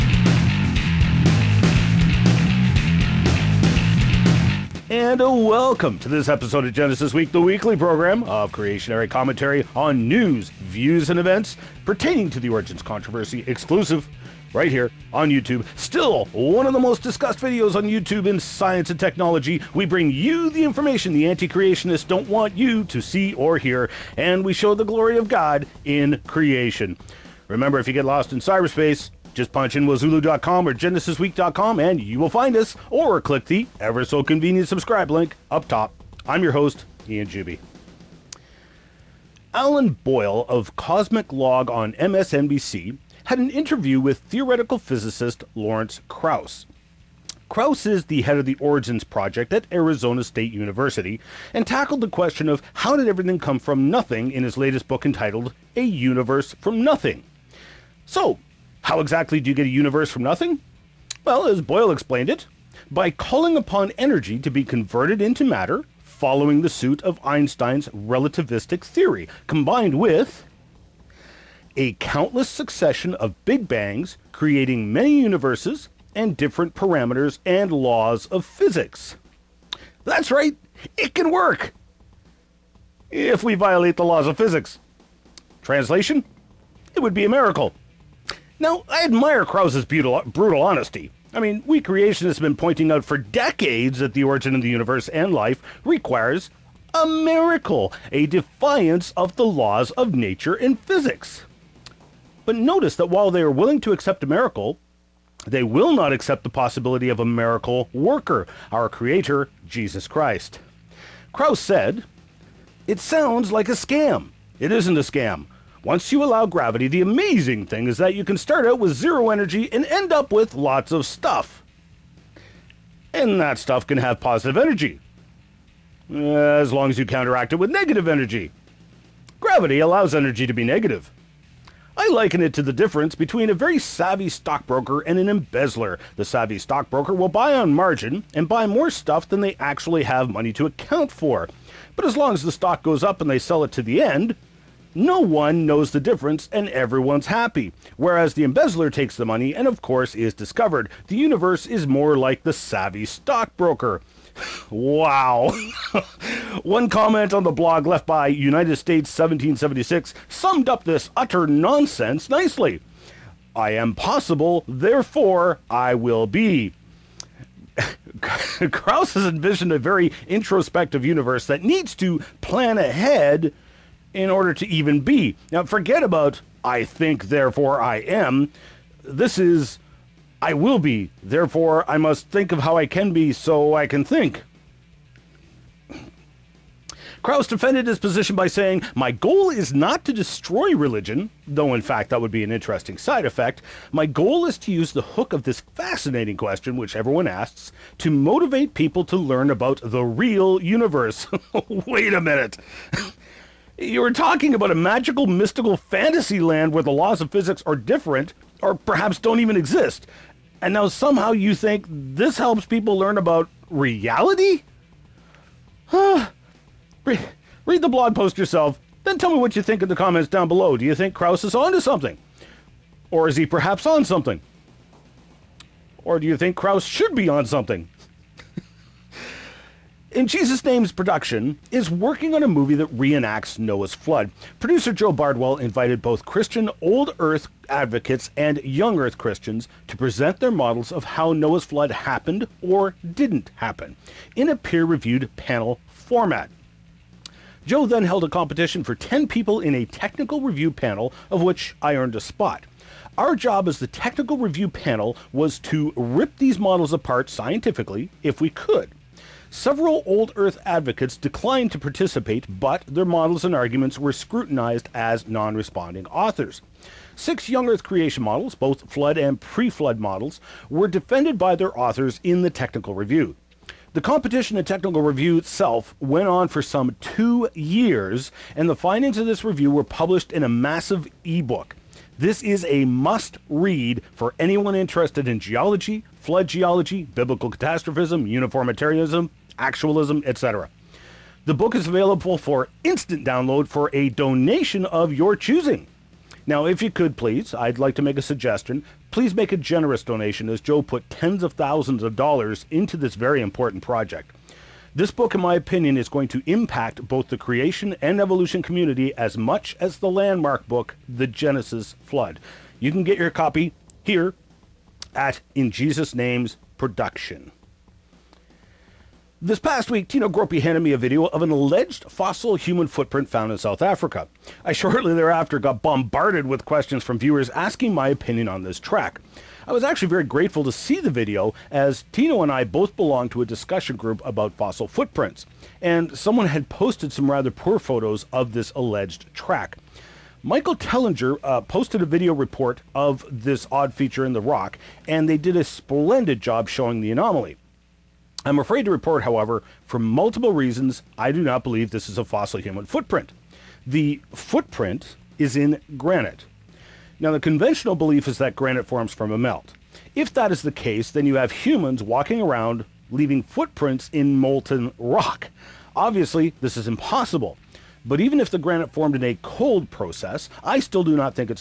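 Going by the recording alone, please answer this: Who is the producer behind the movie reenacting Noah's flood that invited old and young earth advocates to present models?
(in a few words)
Joe Bardwell.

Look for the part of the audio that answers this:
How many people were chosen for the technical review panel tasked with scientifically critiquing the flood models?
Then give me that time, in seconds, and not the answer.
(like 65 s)
248 s.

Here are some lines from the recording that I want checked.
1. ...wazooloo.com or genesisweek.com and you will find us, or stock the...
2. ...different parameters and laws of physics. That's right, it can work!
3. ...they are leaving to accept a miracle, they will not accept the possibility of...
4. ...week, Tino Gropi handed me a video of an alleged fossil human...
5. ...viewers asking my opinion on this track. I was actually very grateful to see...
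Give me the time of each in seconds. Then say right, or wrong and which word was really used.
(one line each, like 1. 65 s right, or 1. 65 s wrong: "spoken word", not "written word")
1. 29 s wrong: "click", not "stock"
2. 76 s right
3. 103 s wrong: "willing", not "leaving"
4. 319 s right
5. 327 s right.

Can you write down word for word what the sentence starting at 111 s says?
Krauss said, It sounds like a scam.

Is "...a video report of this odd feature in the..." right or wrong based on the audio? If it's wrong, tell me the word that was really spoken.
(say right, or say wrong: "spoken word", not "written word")
right.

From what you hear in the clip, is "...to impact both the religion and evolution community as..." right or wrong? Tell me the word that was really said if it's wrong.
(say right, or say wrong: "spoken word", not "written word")
wrong: "creation", not "religion".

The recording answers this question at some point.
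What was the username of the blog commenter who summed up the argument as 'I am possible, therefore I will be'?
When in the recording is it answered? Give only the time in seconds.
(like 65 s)
158 s.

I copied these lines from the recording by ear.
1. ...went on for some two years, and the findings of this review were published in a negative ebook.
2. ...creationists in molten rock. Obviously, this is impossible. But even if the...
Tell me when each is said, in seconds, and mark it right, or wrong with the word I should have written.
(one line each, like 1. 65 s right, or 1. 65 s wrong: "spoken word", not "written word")
1. 275 s wrong: "massive", not "negative"
2. 363 s wrong: "footprints", not "creationists".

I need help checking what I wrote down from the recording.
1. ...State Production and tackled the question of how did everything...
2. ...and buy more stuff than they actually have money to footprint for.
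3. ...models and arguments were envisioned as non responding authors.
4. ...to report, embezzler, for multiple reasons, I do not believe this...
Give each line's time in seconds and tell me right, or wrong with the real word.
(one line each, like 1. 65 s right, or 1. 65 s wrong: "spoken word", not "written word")
1. 50 s wrong: "University", not "Production"
2. 138 s wrong: "account", not "footprint"
3. 263 s wrong: "scrutinized", not "envisioned"
4. 348 s wrong: "however", not "embezzler".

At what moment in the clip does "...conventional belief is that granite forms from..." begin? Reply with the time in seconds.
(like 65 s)
357 s.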